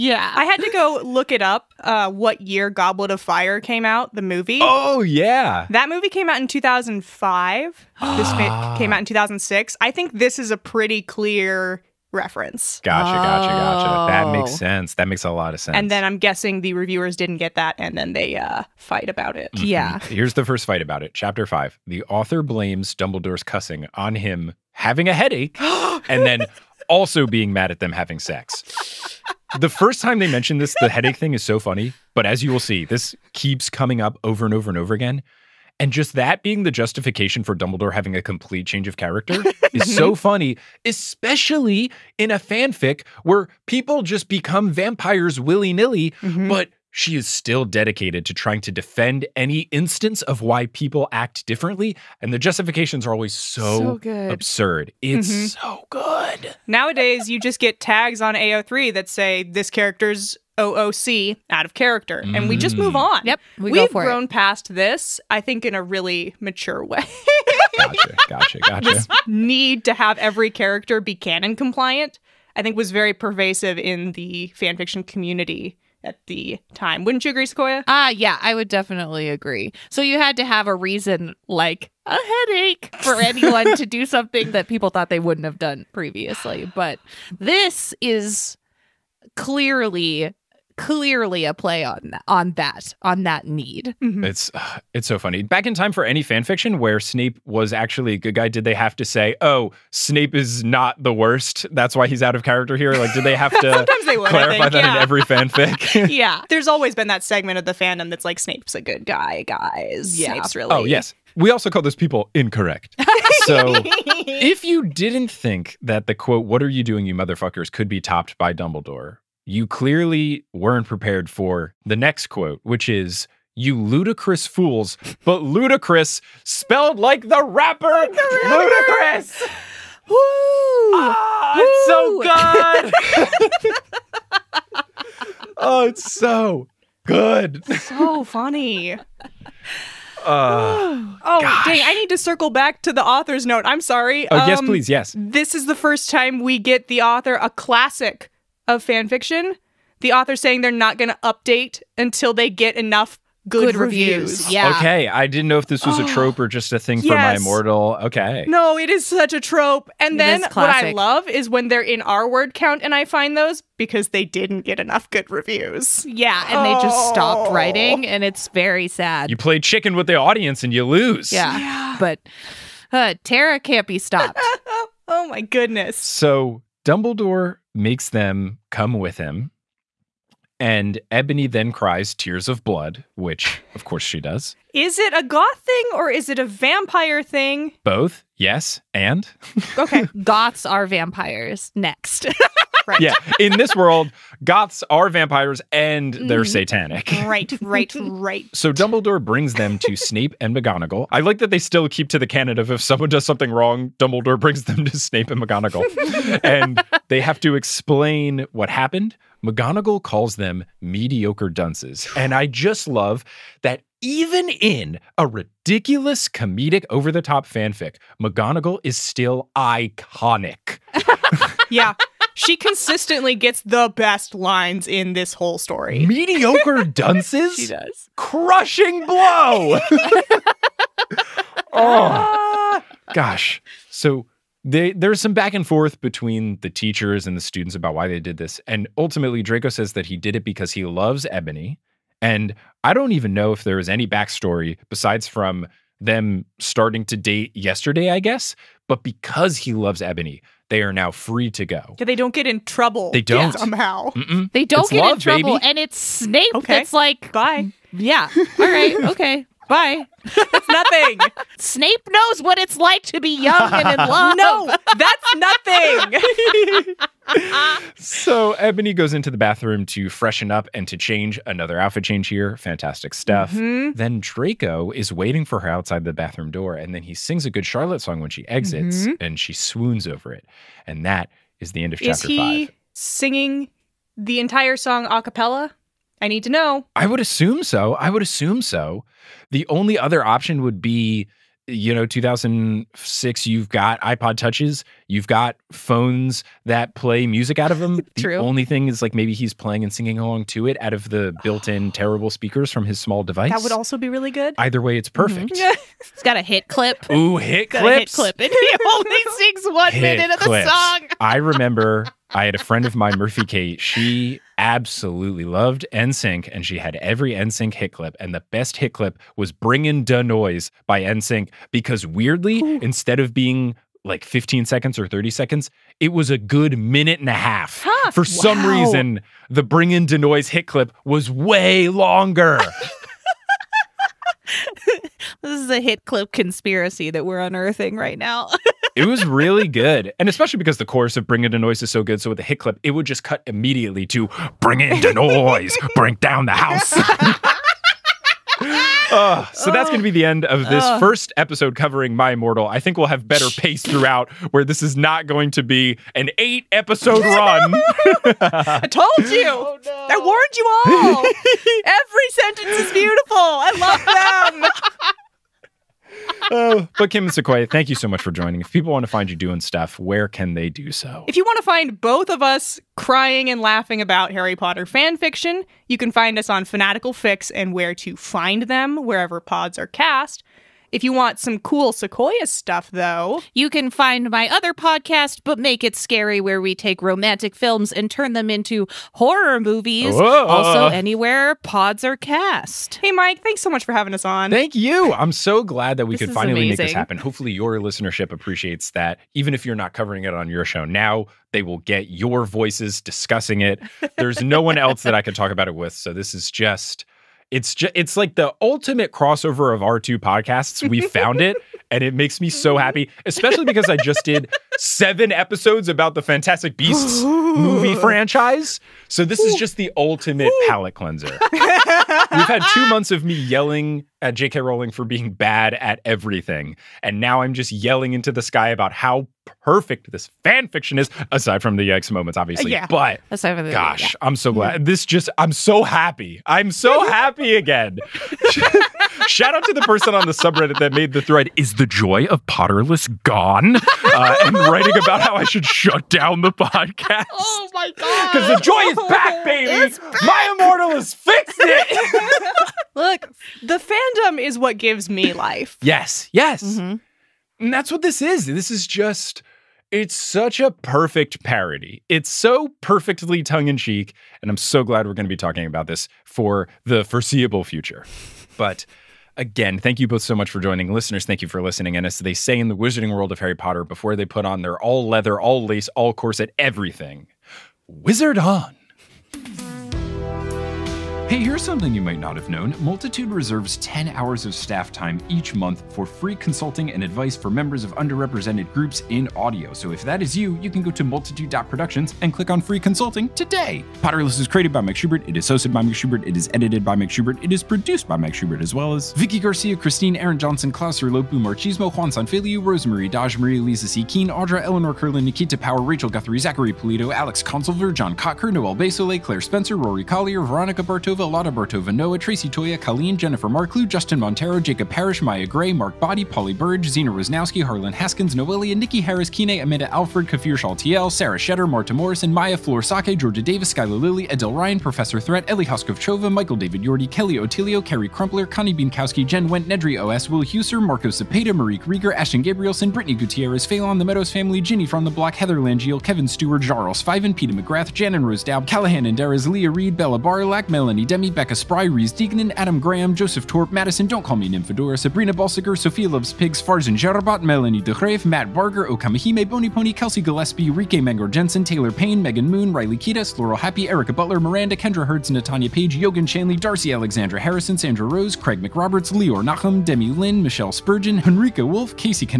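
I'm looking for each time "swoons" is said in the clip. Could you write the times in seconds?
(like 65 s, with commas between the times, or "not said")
279 s.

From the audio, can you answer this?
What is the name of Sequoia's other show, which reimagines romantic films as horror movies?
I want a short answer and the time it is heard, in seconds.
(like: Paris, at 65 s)
But Make It Scary, at 385 s.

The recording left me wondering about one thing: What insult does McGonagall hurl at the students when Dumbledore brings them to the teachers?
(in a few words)
mediocre dunces.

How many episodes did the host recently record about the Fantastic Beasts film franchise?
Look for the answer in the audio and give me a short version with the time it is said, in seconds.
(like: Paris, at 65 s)
7, at 414 s.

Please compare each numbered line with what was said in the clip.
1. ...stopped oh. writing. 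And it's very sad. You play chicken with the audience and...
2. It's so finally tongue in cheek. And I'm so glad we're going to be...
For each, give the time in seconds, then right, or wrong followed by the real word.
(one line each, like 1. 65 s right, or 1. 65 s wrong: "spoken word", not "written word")
1. 167 s right
2. 462 s wrong: "perfectly", not "finally".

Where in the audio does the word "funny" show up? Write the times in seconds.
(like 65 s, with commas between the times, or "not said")
31 s, 40 s, 95 s, 138 s.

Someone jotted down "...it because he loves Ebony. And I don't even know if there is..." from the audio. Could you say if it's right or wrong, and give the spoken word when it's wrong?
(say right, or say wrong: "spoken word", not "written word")
right.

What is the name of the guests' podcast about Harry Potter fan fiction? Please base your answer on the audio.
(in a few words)
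Fanatical Fics and Where to Find Them.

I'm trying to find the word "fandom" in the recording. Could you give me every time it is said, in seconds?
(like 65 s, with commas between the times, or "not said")
107 s, 453 s.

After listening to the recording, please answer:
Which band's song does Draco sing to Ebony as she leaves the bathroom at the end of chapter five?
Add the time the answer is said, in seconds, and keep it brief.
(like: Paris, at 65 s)
Good Charlotte, at 277 s.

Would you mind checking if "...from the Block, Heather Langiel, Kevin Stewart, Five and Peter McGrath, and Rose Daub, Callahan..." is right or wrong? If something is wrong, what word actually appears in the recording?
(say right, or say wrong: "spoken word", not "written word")
right.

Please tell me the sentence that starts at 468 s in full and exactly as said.
But again, thank you both so much for joining.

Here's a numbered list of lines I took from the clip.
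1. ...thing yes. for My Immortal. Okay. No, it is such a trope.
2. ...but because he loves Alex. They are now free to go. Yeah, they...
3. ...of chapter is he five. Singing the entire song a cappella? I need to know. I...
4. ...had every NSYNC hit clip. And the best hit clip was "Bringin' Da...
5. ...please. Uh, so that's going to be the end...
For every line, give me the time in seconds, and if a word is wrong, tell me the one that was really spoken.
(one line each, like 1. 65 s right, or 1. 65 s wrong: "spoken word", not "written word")
1. 156 s right
2. 248 s wrong: "Ebony", not "Alex"
3. 281 s right
4. 316 s right
5. 346 s wrong: "house", not "please".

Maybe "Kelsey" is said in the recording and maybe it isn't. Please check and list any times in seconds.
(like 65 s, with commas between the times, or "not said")
549 s.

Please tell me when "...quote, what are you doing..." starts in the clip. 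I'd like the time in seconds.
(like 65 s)
116 s.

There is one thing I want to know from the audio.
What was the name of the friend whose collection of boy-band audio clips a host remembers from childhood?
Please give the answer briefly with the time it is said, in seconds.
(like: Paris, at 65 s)
Murphy Kate, at 313 s.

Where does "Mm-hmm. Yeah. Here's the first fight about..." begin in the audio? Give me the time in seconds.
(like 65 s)
19 s.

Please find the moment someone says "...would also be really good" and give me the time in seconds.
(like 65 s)
303 s.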